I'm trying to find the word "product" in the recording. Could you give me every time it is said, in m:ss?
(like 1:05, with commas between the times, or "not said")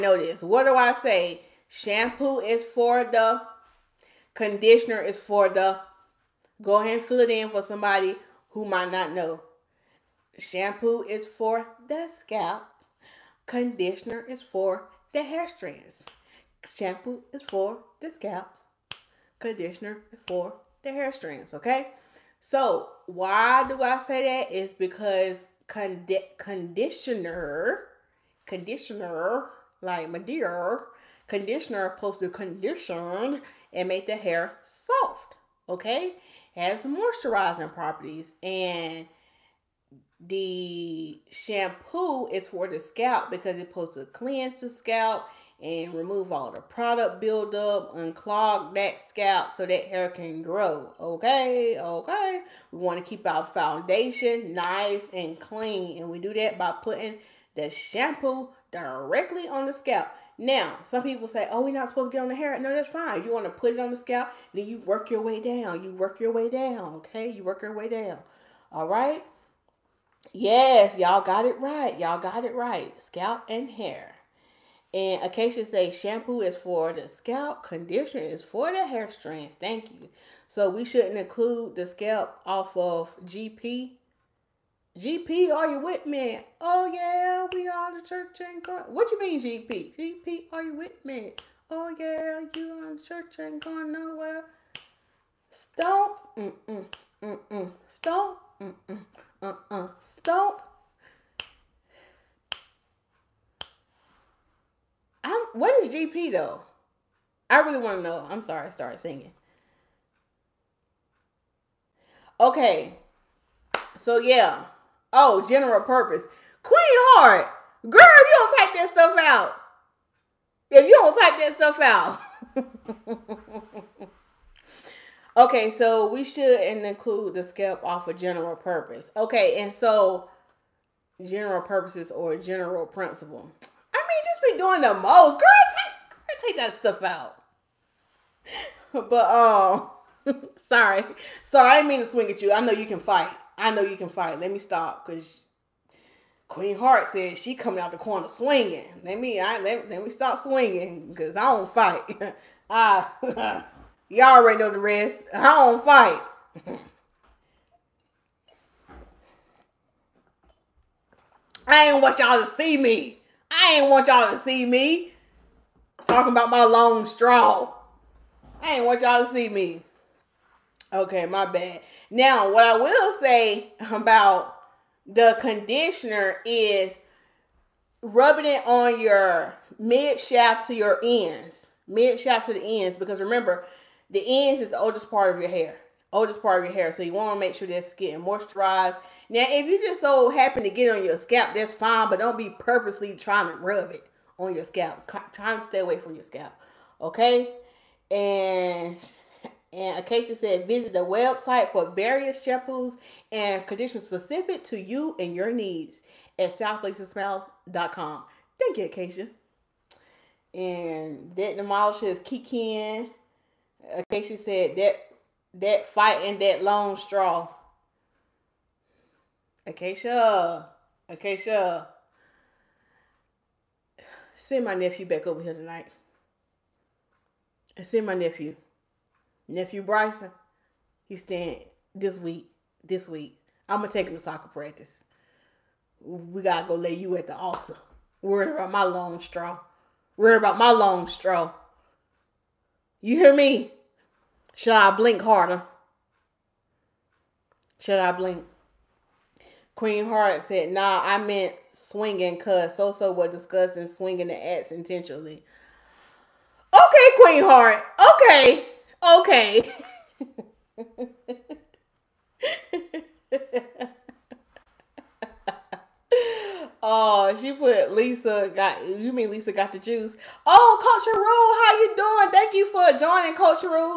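0:46.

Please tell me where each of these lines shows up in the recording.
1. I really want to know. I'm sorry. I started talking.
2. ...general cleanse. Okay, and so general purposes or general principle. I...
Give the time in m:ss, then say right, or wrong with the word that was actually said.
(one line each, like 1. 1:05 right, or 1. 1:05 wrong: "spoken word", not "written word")
1. 1:47 wrong: "singing", not "talking"
2. 2:08 wrong: "purpose", not "cleanse".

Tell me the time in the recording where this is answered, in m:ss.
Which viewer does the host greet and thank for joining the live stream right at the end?
4:30.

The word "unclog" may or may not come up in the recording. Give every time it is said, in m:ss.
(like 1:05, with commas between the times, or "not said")
0:47.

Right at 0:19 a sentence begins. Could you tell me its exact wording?
Conditioner for the hair strands, okay?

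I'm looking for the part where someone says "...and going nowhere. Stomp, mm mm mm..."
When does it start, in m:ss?
1:33.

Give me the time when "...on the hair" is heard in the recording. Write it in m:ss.
1:02.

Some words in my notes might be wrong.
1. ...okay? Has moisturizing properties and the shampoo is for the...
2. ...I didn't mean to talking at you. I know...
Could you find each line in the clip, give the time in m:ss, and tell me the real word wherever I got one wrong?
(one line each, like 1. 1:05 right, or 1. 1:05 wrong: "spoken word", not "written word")
1. 0:35 right
2. 2:21 wrong: "swing", not "talking".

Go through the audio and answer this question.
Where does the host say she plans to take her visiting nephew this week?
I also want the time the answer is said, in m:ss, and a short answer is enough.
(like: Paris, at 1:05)
Soccer practice, at 3:54.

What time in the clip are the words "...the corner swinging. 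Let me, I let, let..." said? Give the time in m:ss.
2:27.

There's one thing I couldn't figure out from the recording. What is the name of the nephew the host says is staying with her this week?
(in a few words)
Bryson.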